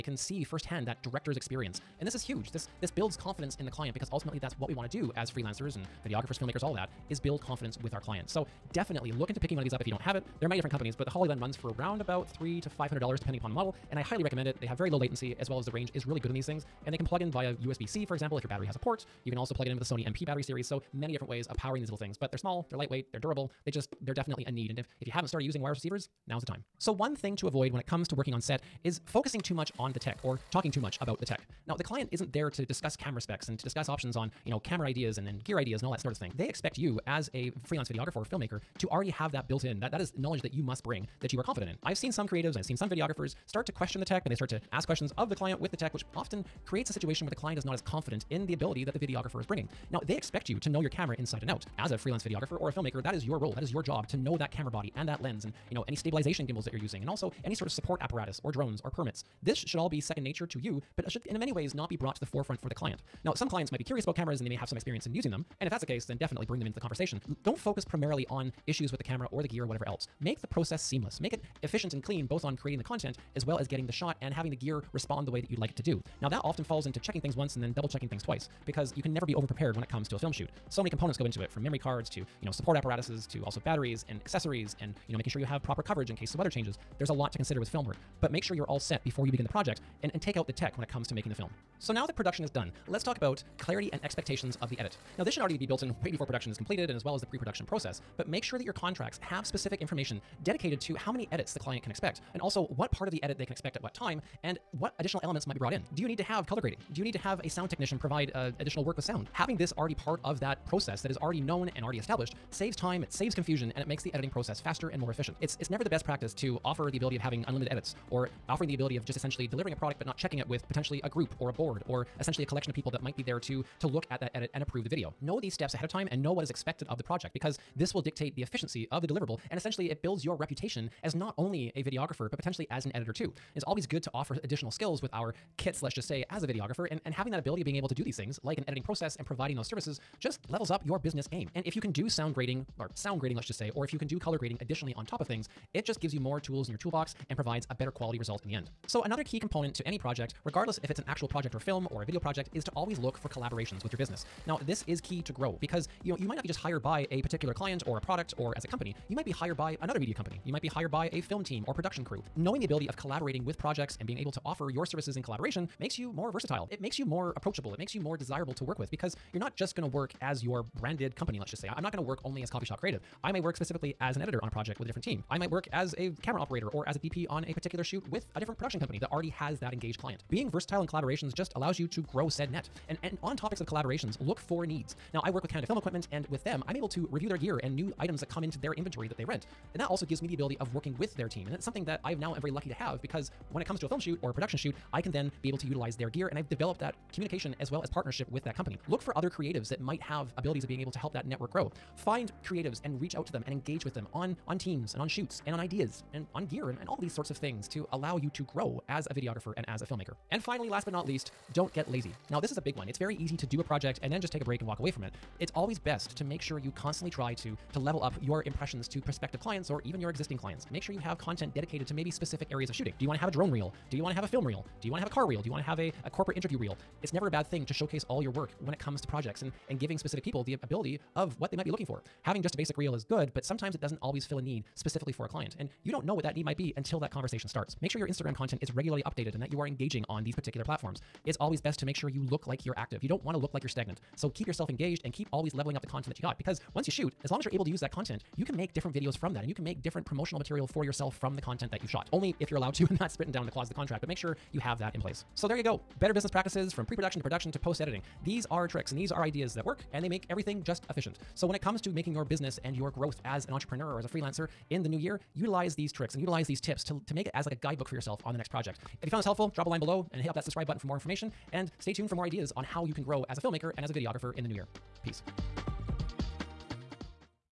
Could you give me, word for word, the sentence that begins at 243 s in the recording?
You don't want to look like you're stagnant.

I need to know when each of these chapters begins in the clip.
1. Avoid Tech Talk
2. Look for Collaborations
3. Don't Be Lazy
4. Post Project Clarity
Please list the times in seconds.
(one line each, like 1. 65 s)
1. 29 s
2. 153 s
3. 210 s
4. 93 s.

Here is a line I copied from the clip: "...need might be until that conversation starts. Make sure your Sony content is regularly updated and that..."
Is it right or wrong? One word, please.
wrong.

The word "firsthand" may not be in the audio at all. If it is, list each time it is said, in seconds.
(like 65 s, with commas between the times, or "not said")
0 s.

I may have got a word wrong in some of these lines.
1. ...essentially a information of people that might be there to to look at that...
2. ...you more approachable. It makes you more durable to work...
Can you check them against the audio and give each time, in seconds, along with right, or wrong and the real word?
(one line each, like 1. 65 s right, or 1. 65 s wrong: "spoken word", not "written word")
1. 122 s wrong: "collection", not "information"
2. 166 s wrong: "desirable", not "durable".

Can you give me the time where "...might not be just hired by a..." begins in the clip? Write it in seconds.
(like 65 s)
156 s.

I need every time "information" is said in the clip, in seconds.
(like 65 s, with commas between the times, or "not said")
99 s, 270 s.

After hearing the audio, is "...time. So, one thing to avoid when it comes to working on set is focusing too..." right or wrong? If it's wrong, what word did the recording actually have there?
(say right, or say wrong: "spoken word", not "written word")
right.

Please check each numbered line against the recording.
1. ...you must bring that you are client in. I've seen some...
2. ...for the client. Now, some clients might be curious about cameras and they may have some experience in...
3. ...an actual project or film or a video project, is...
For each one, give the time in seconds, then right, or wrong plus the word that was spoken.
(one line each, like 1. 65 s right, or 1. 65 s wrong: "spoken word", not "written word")
1. 40 s wrong: "confident", not "client"
2. 62 s right
3. 150 s right.